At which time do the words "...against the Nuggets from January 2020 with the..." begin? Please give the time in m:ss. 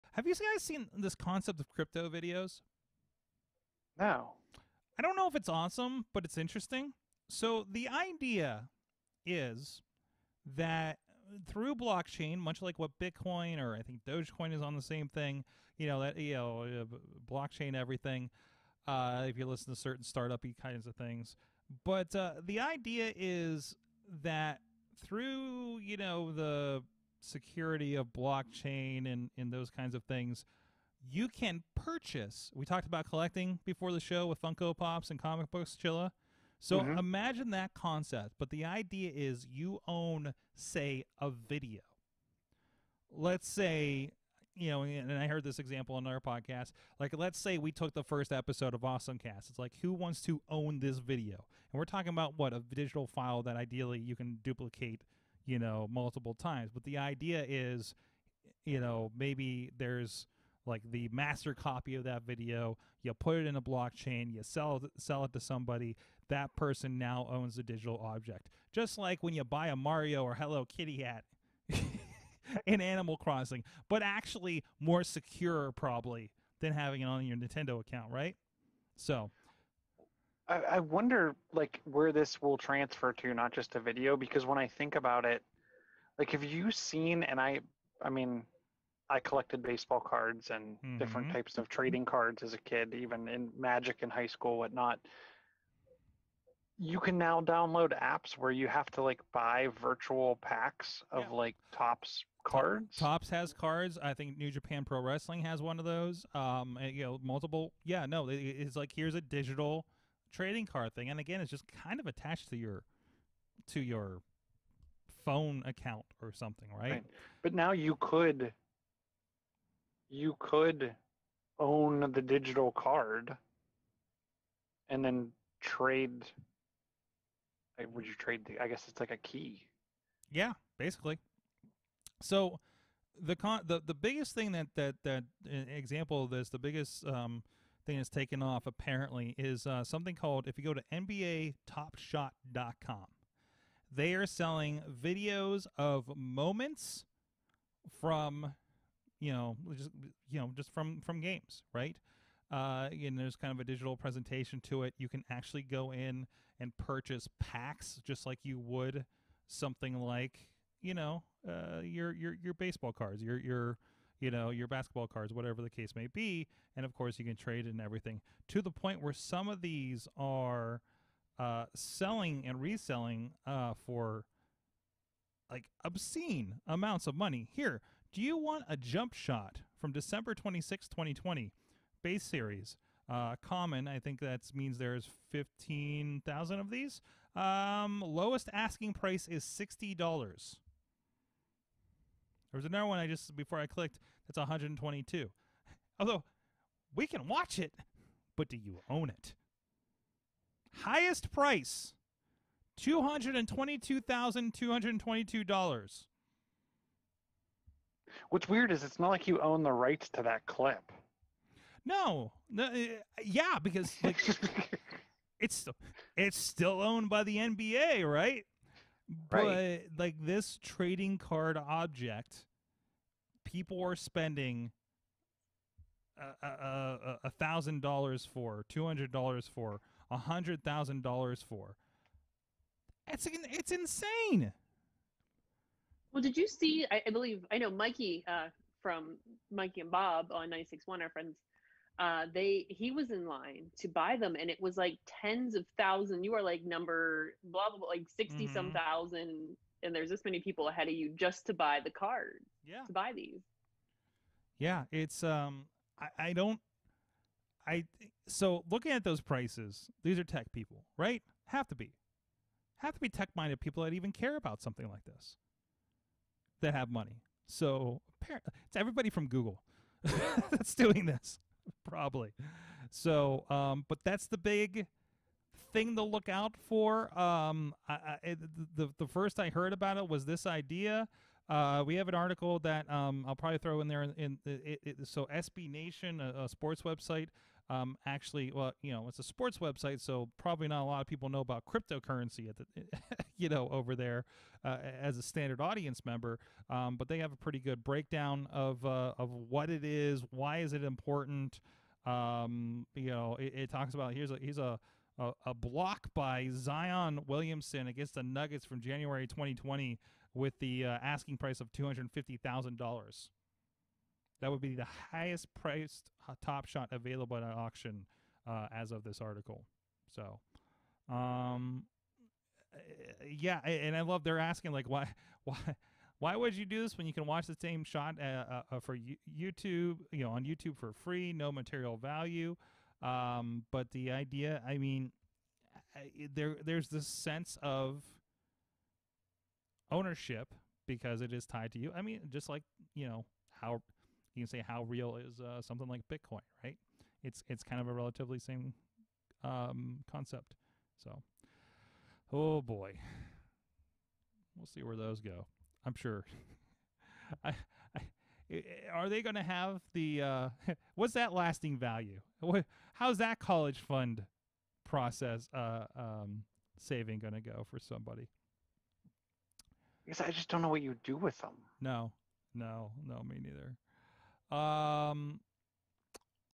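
5:07.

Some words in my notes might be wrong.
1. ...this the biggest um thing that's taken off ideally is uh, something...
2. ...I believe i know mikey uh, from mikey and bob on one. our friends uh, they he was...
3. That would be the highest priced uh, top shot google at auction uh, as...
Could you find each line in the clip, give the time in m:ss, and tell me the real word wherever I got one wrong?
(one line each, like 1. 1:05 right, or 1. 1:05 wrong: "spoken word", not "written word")
1. 2:16 wrong: "apparently", not "ideally"
2. 3:57 right
3. 5:14 wrong: "available", not "google".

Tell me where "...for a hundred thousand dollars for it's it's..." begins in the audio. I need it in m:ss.
3:49.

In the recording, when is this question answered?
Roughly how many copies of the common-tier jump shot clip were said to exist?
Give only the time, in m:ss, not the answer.
3:05.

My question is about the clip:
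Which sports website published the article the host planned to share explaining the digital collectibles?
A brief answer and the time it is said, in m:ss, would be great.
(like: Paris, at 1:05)
SB Nation, at 4:45.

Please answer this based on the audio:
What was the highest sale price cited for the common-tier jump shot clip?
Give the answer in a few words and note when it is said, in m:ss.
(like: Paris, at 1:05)
$222,222, at 3:22.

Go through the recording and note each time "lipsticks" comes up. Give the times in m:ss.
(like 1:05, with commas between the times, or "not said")
not said.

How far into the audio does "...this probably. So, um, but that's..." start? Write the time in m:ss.
4:31.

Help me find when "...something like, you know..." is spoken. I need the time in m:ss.
2:39.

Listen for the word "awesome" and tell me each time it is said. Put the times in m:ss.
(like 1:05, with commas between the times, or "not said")
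0:05, 0:48.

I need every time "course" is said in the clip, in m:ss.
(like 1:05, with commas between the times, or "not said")
2:46.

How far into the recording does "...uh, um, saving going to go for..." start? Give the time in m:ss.
6:05.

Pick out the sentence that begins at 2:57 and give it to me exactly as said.
Here, do you want a jump shot from December 26, 2020, base series?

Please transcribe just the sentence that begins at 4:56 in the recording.
Um, but they have a pretty good breakdown of uh, of what it is, why is it important.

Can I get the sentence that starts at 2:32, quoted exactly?
Uh, and there's kind of a digital presentation to it.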